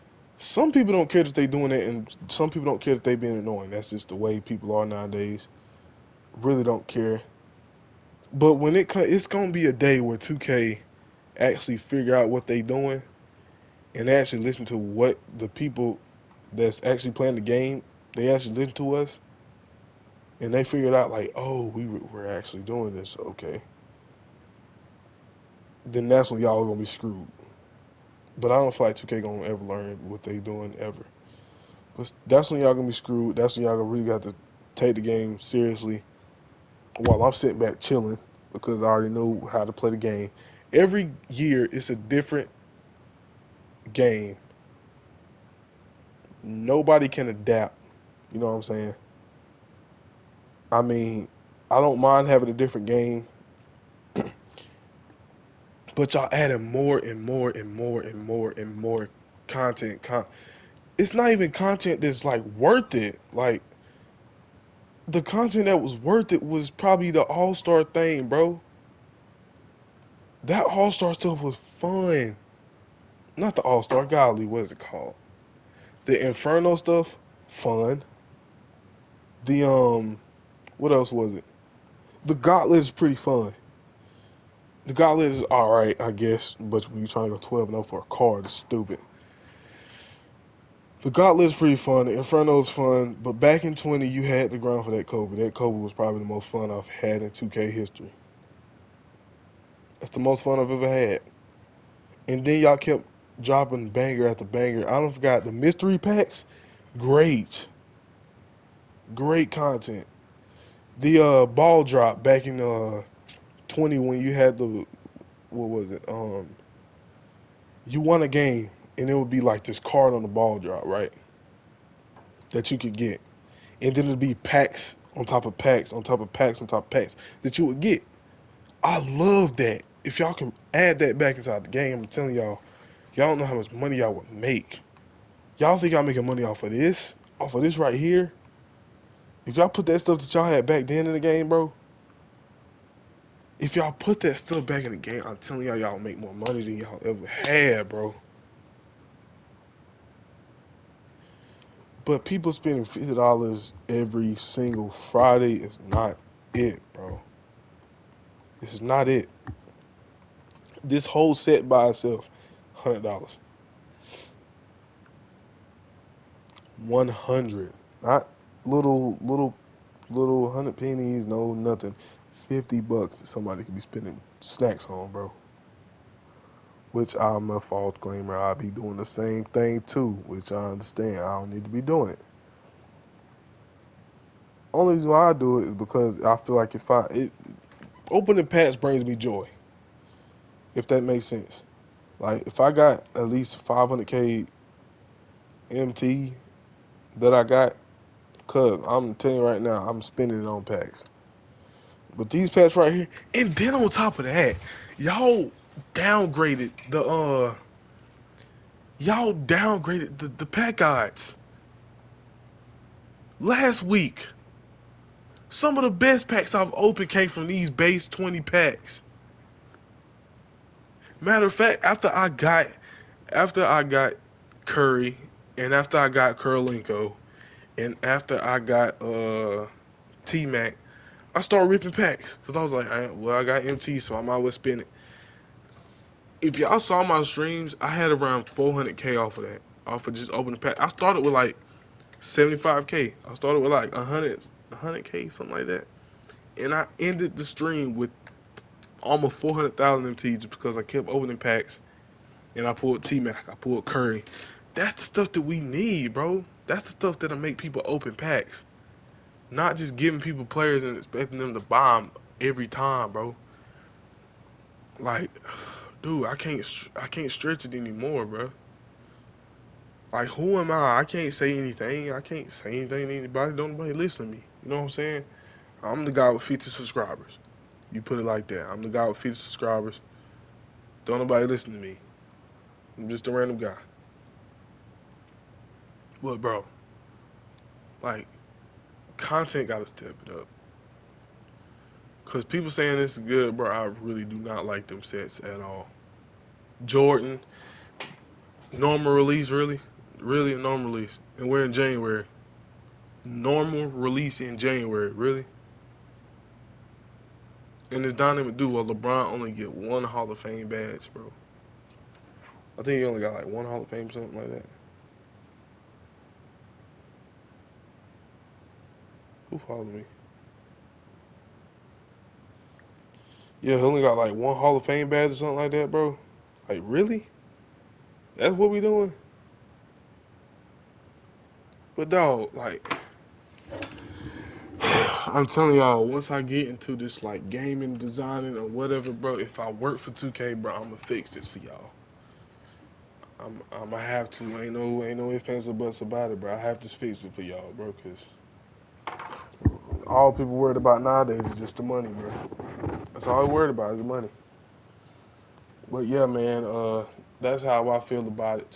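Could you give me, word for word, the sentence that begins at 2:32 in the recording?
But people spending fifty dollars every single Friday is not it, bro.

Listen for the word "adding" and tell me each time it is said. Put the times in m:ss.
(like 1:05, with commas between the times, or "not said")
0:56.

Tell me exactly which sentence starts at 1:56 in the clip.
Um, you won a game and it would be like this card on the ball drop, right?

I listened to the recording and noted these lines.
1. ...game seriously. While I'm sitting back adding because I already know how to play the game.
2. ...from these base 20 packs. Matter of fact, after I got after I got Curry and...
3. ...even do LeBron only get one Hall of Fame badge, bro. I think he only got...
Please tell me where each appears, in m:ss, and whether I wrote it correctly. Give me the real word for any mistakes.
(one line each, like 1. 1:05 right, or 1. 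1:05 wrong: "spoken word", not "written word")
1. 0:35 wrong: "chilling", not "adding"
2. 3:37 right
3. 5:08 right.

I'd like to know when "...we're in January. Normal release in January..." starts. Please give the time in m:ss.
5:01.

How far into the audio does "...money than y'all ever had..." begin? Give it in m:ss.
2:26.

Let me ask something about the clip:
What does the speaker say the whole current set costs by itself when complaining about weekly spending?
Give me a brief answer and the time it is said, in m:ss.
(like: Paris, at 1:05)
100 dollars, at 2:42.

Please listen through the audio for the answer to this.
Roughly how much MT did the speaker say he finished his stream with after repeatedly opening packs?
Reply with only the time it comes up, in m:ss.
4:09.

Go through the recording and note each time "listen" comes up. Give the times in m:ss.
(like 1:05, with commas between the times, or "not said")
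0:14, 0:18, 4:33, 4:41.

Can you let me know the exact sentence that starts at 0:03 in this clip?
That's just the way people are nowadays.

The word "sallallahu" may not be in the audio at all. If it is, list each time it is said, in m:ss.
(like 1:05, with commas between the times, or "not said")
not said.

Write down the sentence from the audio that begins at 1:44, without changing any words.
I don't forgot the mystery packs.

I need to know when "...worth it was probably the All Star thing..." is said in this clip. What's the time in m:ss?
1:05.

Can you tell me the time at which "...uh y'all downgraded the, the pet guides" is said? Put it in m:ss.
3:27.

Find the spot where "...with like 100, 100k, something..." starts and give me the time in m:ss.
4:03.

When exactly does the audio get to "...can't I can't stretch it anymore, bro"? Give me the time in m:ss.
4:26.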